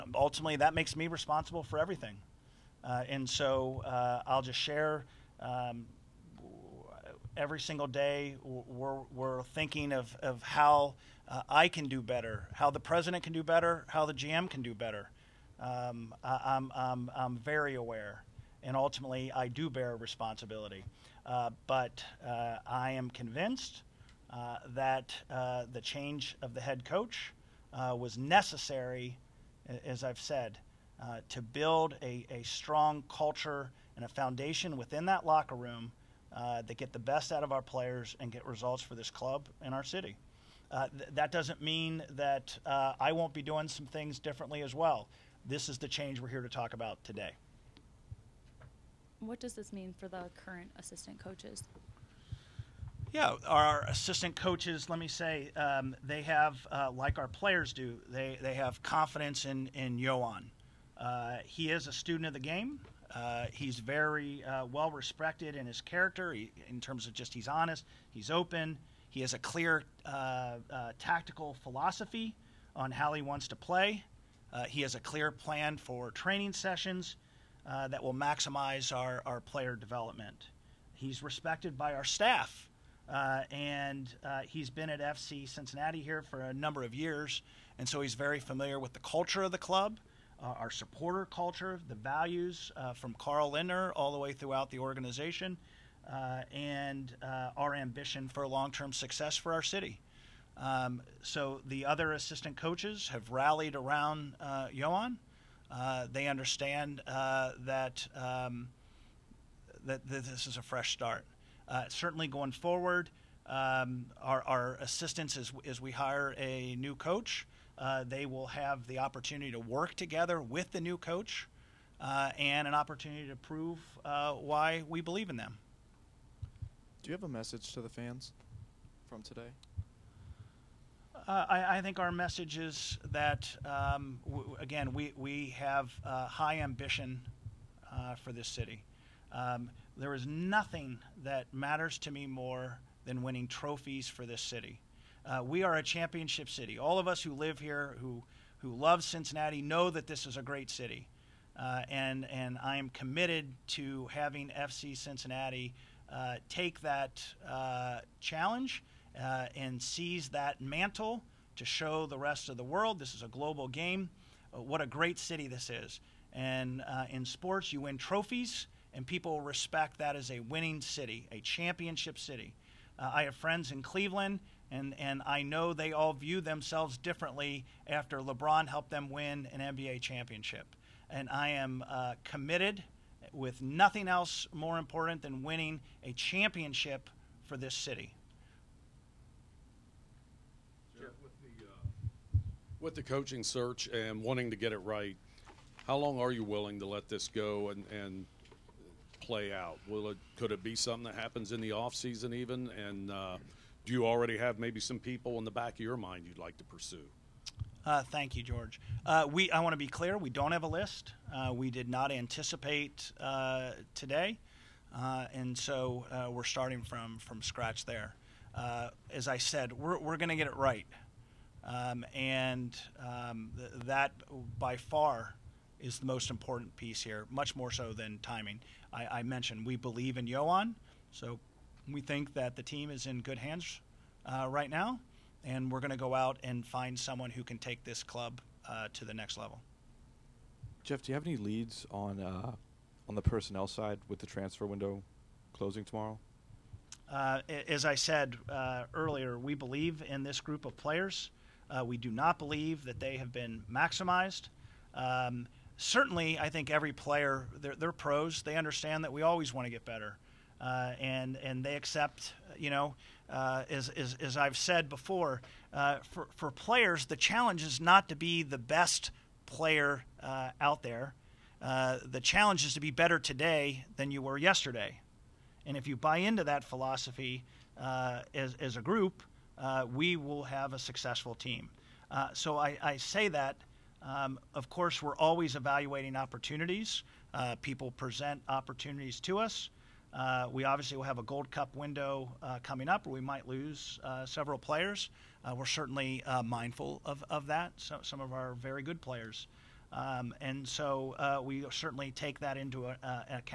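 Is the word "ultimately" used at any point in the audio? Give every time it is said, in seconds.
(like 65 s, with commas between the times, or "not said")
0 s, 18 s.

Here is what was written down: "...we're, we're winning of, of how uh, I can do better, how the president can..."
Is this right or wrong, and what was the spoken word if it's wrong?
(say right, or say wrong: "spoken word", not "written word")
wrong: "thinking", not "winning".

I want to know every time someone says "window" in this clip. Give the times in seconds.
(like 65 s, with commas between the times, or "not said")
244 s, 291 s.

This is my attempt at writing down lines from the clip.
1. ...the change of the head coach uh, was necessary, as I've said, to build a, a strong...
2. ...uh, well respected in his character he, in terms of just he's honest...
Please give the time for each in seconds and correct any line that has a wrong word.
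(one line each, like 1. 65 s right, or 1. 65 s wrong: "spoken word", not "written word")
1. 25 s right
2. 64 s right.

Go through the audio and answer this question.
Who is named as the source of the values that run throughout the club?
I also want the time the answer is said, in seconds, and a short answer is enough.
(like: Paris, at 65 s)
Carl Lindner, at 93 s.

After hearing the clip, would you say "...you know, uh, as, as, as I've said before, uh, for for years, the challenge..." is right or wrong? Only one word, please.
wrong.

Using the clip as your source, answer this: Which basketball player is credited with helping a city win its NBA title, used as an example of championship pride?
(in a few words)
LeBron.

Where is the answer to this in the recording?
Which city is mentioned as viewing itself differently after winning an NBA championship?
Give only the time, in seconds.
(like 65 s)
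173 s.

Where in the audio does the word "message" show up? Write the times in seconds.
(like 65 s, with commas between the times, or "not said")
127 s, 132 s.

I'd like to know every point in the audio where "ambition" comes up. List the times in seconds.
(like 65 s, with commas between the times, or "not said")
97 s, 136 s.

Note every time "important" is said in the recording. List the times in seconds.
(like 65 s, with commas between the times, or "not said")
184 s, 226 s.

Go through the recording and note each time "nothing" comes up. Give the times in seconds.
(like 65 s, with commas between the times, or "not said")
140 s, 183 s.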